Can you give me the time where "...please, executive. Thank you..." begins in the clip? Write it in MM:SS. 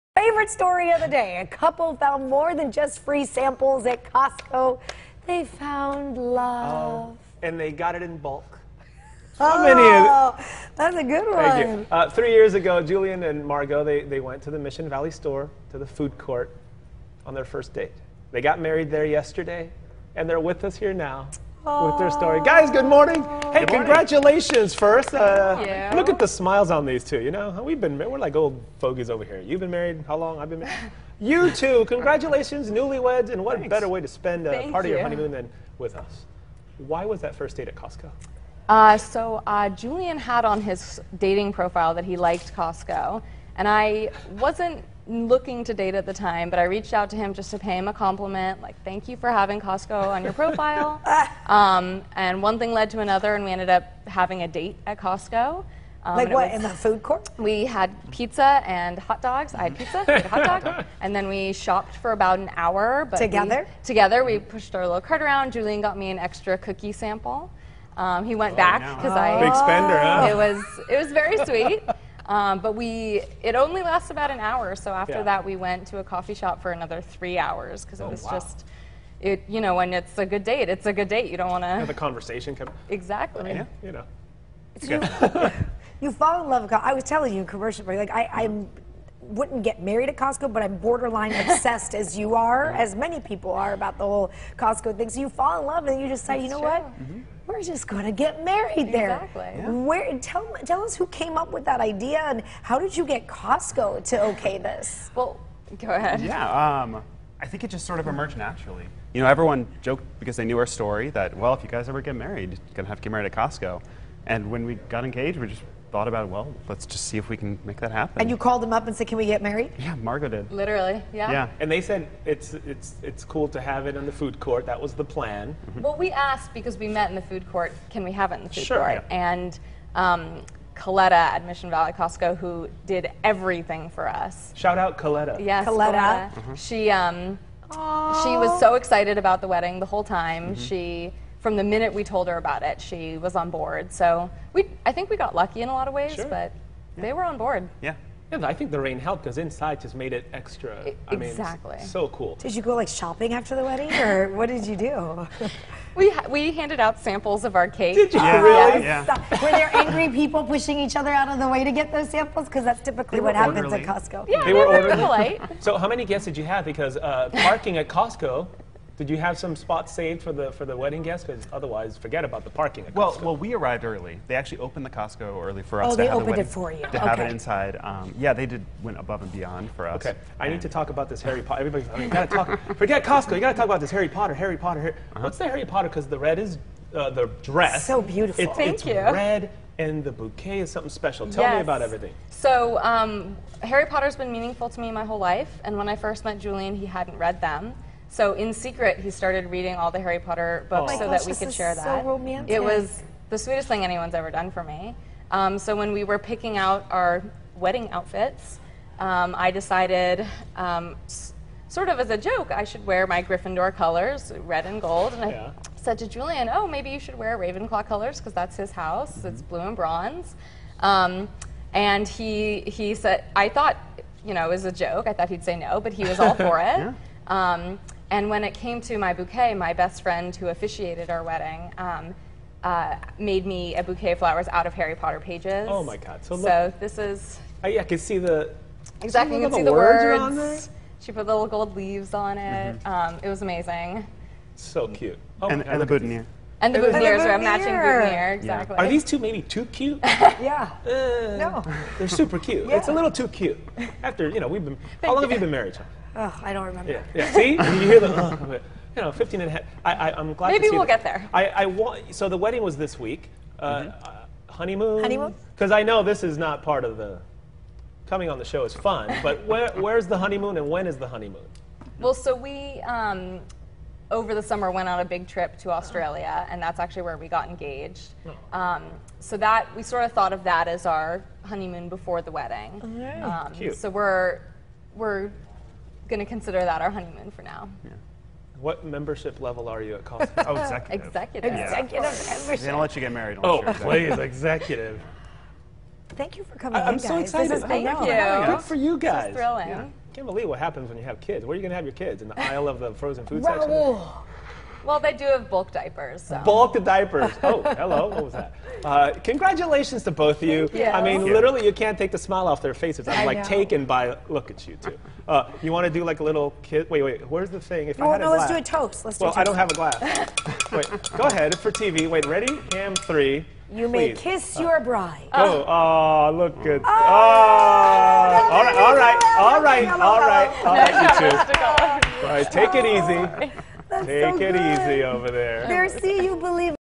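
04:53.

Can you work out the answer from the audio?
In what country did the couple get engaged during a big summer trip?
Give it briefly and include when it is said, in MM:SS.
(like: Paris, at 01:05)
Australia, at 04:35.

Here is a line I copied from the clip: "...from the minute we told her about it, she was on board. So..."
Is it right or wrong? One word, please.
right.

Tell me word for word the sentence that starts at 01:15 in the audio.
that, we went to a coffee shop for another three hours because it oh, was wow.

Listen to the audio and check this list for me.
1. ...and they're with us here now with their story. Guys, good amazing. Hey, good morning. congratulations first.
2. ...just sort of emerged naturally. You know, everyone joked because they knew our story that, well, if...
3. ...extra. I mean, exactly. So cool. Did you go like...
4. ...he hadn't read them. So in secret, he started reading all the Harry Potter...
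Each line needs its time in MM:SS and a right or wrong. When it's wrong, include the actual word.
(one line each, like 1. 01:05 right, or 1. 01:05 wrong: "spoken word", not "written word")
1. 00:20 wrong: "morning", not "amazing"
2. 01:47 right
3. 02:30 right
4. 03:16 right.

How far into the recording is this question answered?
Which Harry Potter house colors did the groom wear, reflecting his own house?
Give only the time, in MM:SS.
03:37.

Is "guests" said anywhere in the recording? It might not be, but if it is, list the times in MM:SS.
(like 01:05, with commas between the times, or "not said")
02:46, 02:51.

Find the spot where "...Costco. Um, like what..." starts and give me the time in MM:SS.
00:54.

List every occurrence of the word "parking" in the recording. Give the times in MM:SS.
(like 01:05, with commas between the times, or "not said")
02:47, 02:52.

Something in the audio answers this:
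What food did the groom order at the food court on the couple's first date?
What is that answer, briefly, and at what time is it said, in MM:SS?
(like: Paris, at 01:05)
Hot dog, at 01:00.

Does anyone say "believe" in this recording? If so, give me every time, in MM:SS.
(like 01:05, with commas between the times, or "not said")
05:00, 05:36.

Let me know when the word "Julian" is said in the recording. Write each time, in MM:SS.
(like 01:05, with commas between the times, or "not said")
00:12, 00:39, 01:05, 03:16, 03:36.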